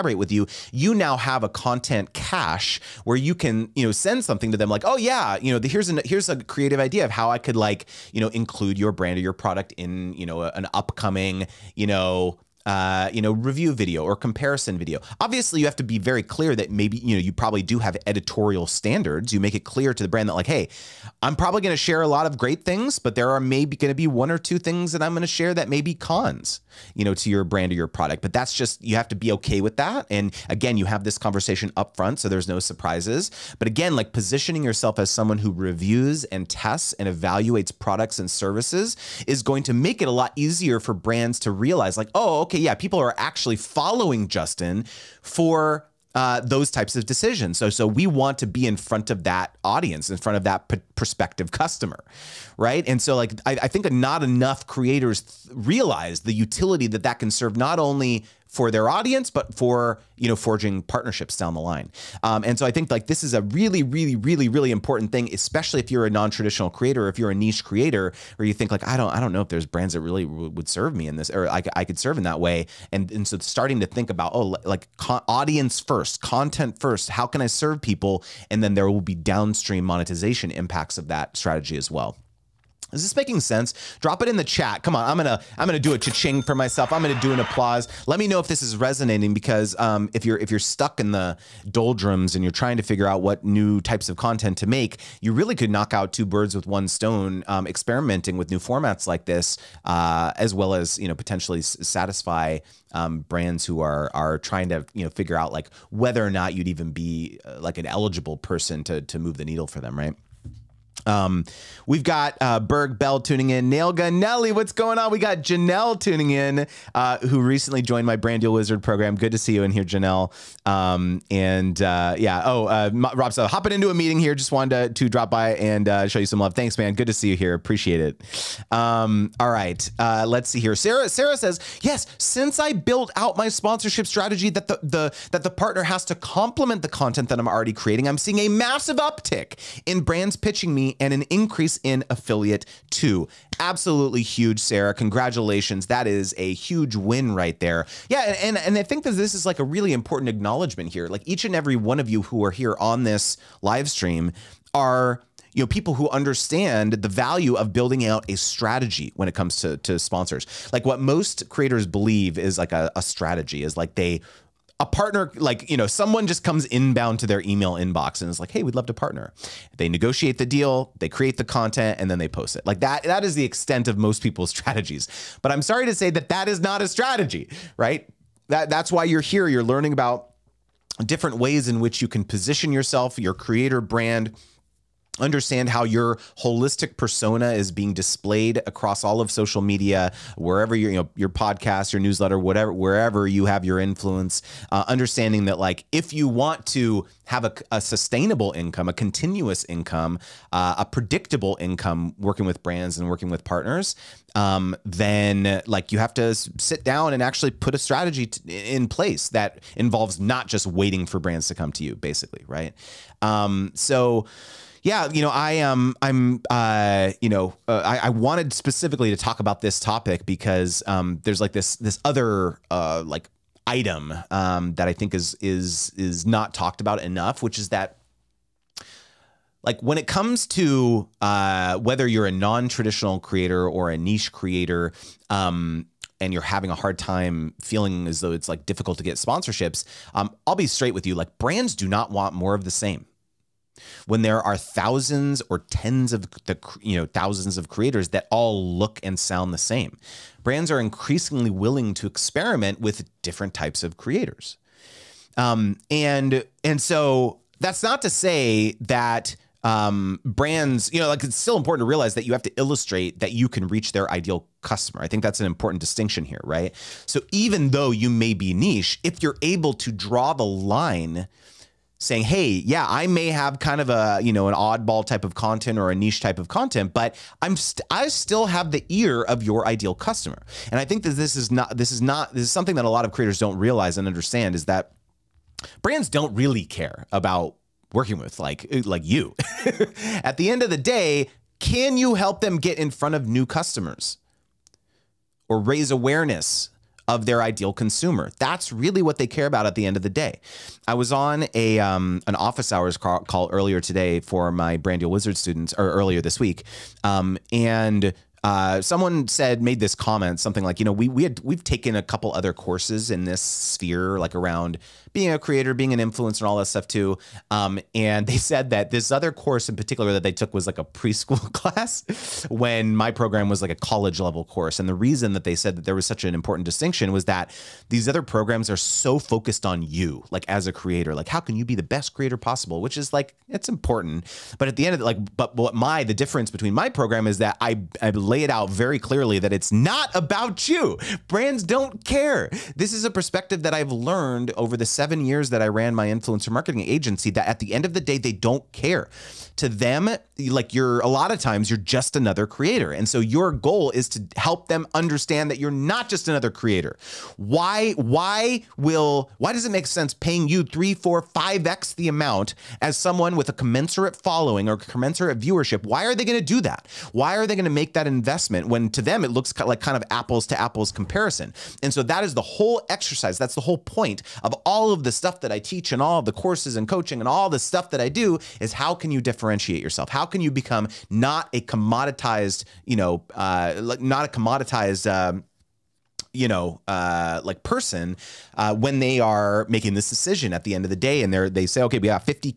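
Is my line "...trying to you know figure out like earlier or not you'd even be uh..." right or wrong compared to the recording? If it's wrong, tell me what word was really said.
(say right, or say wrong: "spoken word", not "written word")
wrong: "whether", not "earlier".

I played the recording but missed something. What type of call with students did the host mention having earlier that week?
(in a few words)
Office hours.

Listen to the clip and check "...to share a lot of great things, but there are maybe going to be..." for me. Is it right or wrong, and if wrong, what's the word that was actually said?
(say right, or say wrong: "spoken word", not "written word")
right.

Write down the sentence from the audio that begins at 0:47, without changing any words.
So, so we want to be in front of that audience, in front of that prospective customer, right?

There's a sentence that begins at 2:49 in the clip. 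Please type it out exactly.
They negotiate the deal, they create the content, and then they post it.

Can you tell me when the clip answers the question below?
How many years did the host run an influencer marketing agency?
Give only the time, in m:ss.
5:44.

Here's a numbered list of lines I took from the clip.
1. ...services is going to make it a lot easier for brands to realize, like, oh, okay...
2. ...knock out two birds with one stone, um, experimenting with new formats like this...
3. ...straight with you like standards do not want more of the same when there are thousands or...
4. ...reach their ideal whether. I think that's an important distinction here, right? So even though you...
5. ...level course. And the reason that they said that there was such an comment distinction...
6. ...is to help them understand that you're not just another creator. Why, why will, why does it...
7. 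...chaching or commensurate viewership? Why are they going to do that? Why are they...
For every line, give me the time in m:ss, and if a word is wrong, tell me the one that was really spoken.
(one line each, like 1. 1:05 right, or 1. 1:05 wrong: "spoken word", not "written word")
1. 0:38 right
2. 1:35 right
3. 4:00 wrong: "brands", not "standards"
4. 4:23 wrong: "customer", not "whether"
5. 5:24 wrong: "important", not "comment"
6. 5:53 right
7. 6:04 wrong: "following", not "chaching".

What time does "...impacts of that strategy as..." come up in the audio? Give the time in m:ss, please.
1:20.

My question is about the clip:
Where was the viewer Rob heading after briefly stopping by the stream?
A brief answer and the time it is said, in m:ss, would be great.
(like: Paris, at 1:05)
Into a meeting, at 2:03.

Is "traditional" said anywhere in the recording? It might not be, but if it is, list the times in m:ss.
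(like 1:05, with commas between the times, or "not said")
1:06, 3:52.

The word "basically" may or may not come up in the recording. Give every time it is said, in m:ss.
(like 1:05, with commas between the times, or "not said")
3:31.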